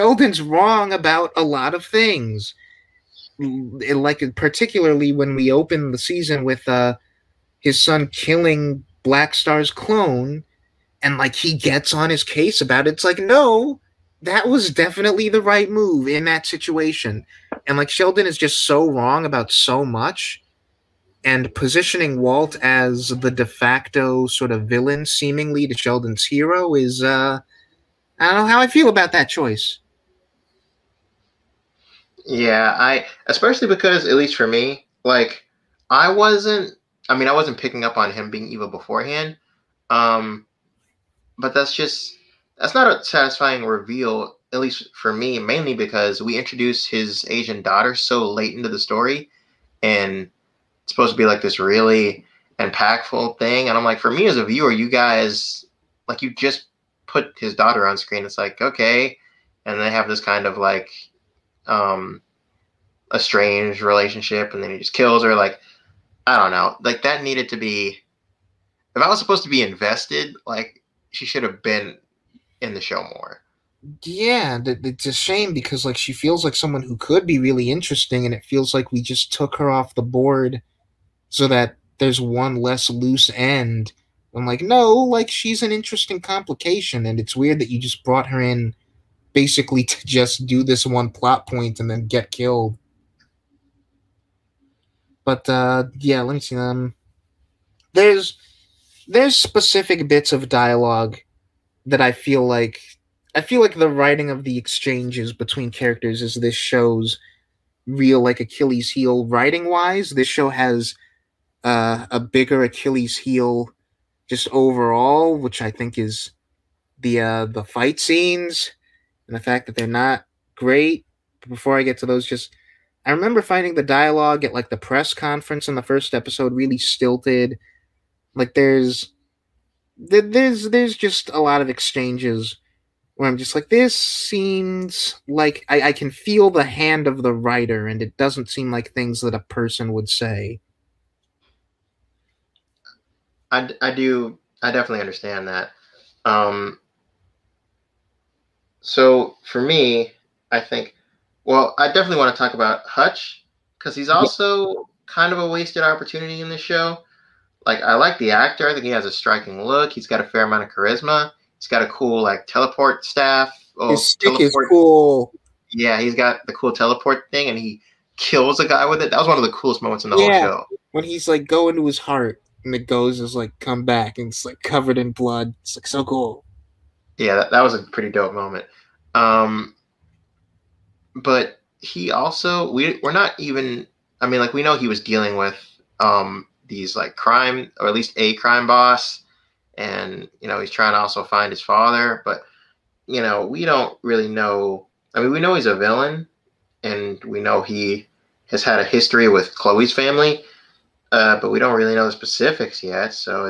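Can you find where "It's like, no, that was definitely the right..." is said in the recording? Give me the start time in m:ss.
0:12.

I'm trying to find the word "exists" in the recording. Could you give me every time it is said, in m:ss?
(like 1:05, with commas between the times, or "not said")
not said.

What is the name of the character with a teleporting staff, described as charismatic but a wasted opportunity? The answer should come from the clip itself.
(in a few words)
Hutch.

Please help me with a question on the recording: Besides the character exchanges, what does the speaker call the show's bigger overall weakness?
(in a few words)
the fight scenes.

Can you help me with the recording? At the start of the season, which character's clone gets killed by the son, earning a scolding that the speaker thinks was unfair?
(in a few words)
Black Star.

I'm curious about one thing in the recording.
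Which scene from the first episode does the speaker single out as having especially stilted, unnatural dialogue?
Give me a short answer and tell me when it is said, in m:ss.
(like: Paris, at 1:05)
the press conference, at 2:04.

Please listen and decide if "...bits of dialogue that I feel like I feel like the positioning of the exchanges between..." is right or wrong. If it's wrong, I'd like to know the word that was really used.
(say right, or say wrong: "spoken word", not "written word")
wrong: "writing", not "positioning".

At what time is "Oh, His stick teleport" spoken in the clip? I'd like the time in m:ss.
2:43.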